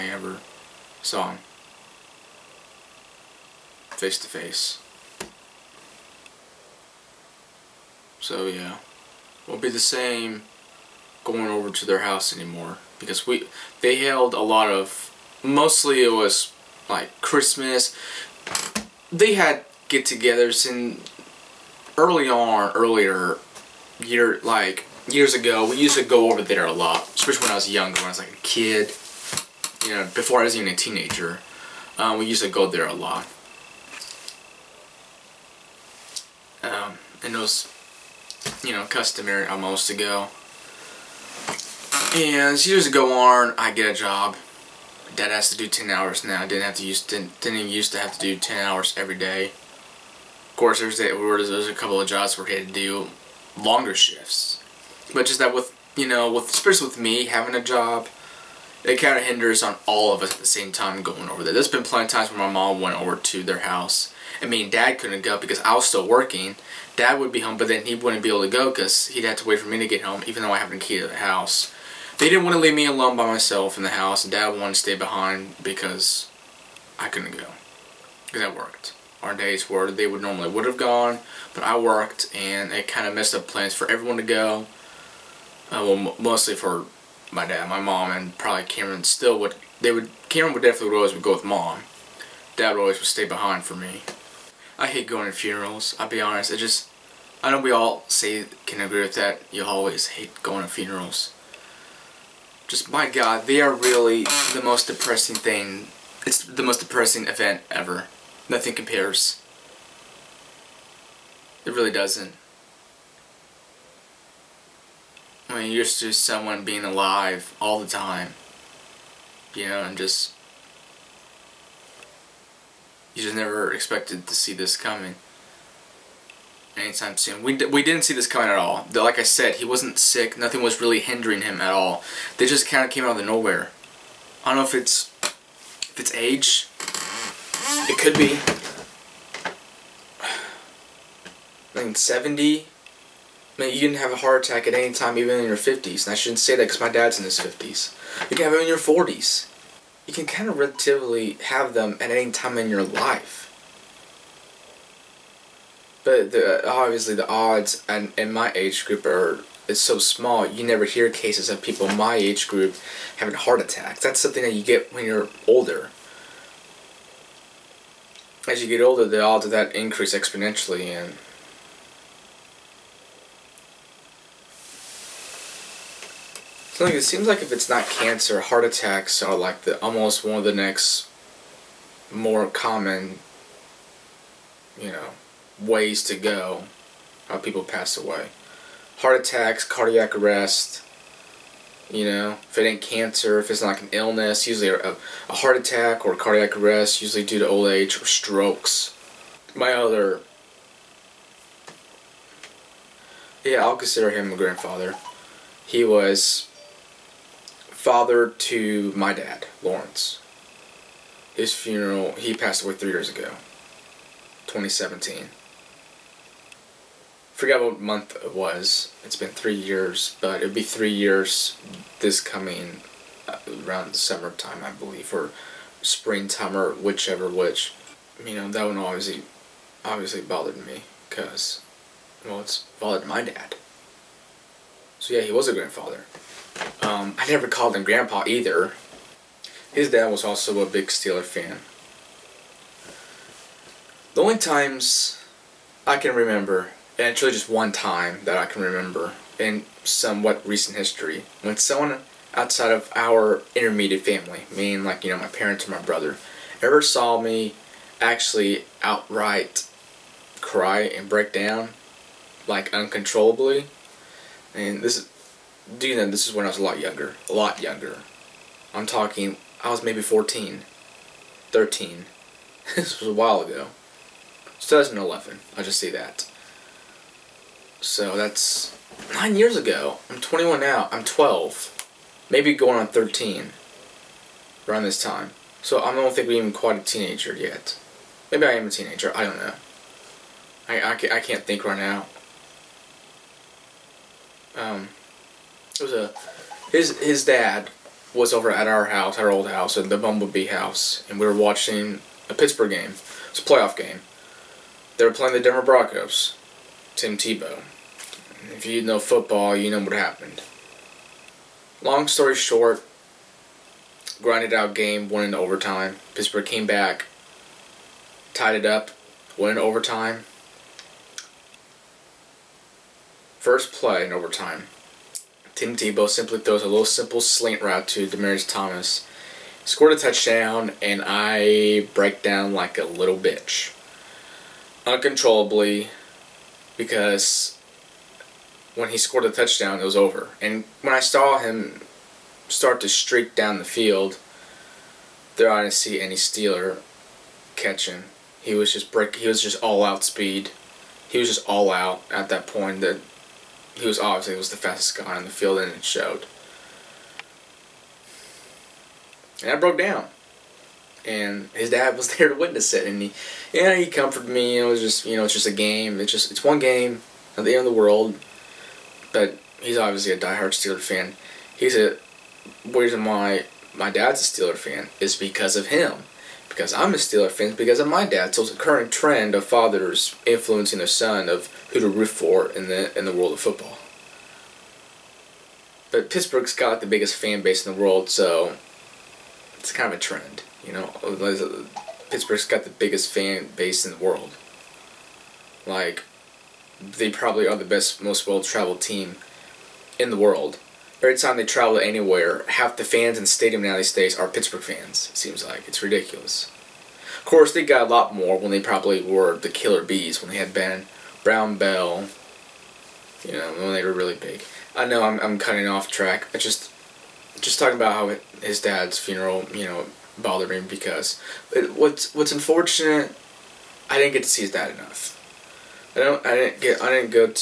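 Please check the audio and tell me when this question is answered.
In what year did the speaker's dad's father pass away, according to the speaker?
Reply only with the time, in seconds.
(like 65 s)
214 s.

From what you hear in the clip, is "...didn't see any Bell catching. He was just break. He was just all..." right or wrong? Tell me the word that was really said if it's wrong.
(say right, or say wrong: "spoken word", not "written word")
wrong: "Steeler", not "Bell".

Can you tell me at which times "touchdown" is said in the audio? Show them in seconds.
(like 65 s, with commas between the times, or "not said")
329 s, 339 s.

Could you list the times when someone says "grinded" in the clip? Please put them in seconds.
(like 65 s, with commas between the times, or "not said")
314 s.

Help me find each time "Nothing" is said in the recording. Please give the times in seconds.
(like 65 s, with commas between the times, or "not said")
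108 s, 130 s.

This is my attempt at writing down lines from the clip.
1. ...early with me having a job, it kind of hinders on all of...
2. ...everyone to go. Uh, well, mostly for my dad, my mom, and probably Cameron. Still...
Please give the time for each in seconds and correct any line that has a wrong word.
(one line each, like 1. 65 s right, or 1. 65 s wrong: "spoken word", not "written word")
1. 56 s wrong: "especially", not "early"
2. 83 s right.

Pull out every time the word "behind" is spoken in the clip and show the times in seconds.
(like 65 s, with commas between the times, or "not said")
74 s, 93 s.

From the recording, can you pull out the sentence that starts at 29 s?
You know, before I was even a teenager, um, we used to go there a lot.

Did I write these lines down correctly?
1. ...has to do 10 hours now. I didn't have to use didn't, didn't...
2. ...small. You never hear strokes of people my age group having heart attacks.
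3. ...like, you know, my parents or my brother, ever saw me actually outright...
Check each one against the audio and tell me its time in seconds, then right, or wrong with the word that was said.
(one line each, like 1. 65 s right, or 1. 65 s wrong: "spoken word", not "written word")
1. 45 s right
2. 159 s wrong: "cases", not "strokes"
3. 254 s right.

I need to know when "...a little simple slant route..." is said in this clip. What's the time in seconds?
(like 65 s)
326 s.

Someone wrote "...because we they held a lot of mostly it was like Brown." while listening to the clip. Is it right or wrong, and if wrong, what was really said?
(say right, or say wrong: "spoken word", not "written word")
wrong: "Christmas", not "Brown".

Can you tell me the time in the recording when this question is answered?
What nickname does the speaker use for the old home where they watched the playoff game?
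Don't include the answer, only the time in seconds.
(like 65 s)
299 s.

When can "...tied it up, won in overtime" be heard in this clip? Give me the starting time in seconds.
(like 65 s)
318 s.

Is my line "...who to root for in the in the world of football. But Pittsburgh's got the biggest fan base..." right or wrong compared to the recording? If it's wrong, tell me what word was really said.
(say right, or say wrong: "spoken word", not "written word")
right.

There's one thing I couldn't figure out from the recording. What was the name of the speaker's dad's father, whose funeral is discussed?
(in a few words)
Lawrence.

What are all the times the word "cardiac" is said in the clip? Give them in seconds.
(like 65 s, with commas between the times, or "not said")
189 s, 196 s.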